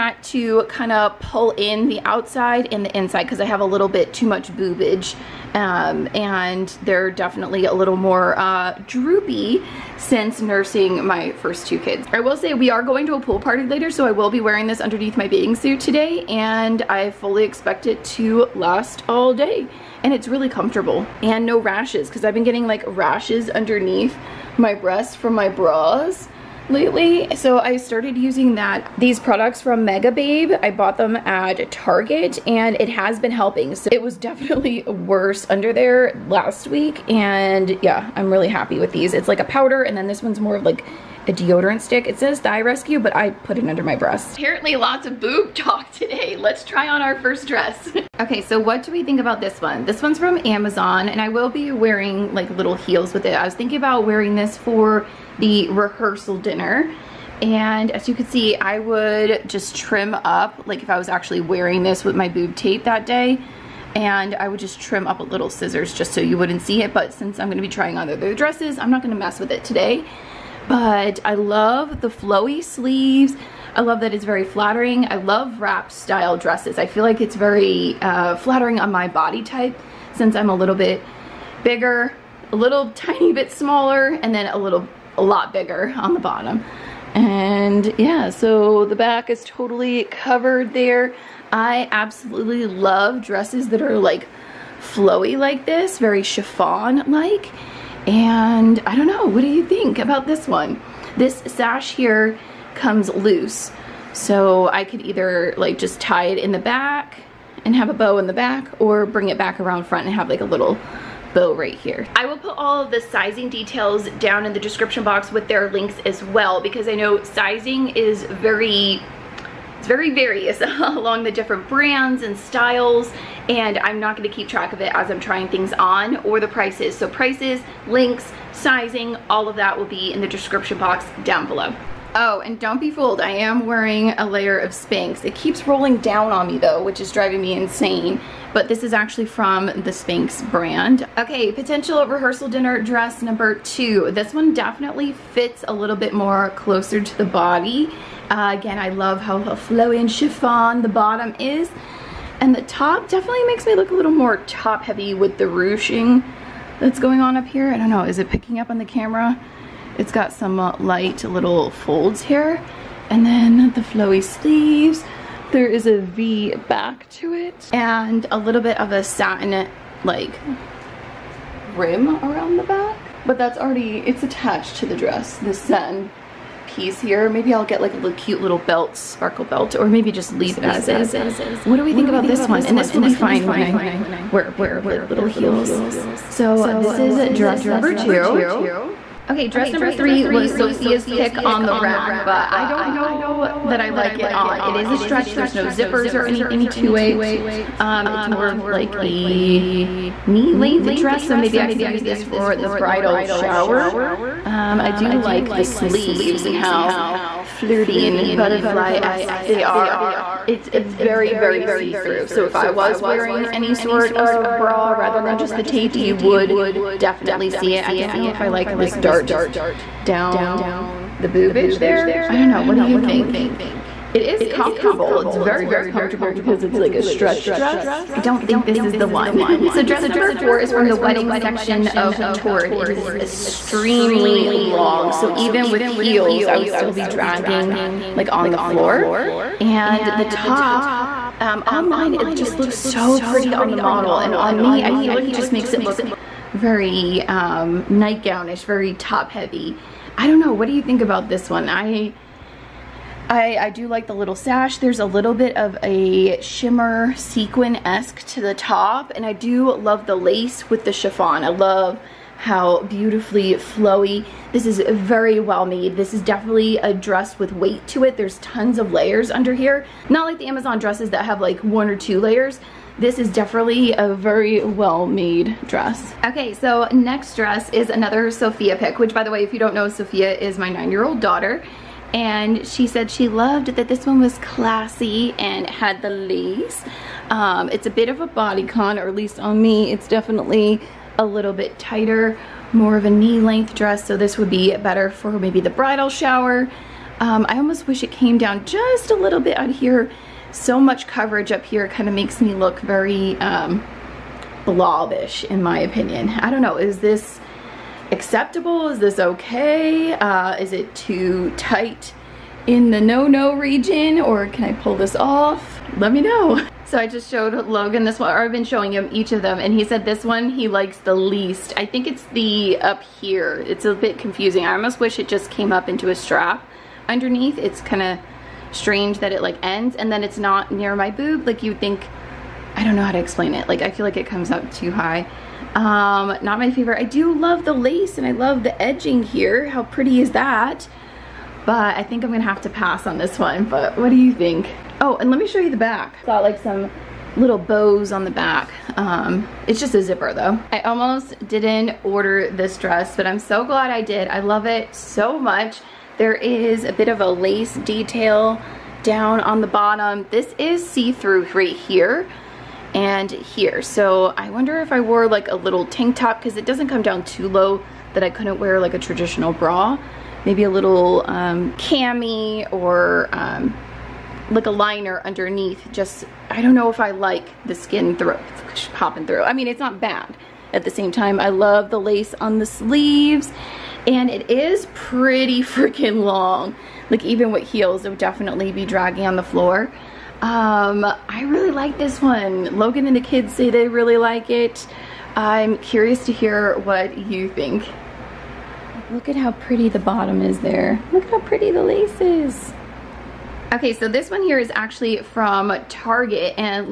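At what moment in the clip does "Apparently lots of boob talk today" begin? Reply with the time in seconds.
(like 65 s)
44 s.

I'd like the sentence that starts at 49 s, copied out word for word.
This one's from Amazon, and I will be wearing like little heels with it.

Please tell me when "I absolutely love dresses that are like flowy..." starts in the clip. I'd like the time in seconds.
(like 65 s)
91 s.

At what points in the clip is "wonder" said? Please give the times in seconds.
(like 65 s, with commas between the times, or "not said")
364 s.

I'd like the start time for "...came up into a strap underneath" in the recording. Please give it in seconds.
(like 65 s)
325 s.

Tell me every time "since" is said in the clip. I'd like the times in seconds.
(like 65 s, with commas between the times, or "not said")
9 s, 67 s, 80 s.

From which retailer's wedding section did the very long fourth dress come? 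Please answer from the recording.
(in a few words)
Torrid.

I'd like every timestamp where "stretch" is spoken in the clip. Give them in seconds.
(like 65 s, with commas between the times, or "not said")
194 s, 227 s.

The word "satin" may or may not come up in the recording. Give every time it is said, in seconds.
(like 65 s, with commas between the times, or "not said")
169 s, 175 s.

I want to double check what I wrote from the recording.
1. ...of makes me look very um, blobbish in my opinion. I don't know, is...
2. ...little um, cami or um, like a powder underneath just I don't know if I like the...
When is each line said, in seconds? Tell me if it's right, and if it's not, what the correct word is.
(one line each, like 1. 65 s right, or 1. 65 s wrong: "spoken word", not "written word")
1. 302 s right
2. 370 s wrong: "liner", not "powder".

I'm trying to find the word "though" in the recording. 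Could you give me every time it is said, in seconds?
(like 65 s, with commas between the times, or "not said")
136 s, 350 s.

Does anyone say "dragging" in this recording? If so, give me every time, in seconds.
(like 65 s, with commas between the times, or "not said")
237 s, 388 s.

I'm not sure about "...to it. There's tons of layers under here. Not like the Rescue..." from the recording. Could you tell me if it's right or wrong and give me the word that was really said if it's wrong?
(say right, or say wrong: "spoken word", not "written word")
wrong: "Amazon", not "Rescue".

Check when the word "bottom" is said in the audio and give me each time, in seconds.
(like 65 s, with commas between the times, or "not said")
86 s, 150 s, 359 s, 399 s.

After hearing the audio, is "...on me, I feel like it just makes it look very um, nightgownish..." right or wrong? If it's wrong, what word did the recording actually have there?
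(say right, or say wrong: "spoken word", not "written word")
right.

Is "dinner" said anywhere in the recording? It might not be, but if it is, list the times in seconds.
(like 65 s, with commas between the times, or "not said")
56 s, 142 s.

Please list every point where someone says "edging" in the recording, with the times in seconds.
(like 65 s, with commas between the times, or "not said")
338 s.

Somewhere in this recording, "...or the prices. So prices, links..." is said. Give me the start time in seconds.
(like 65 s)
126 s.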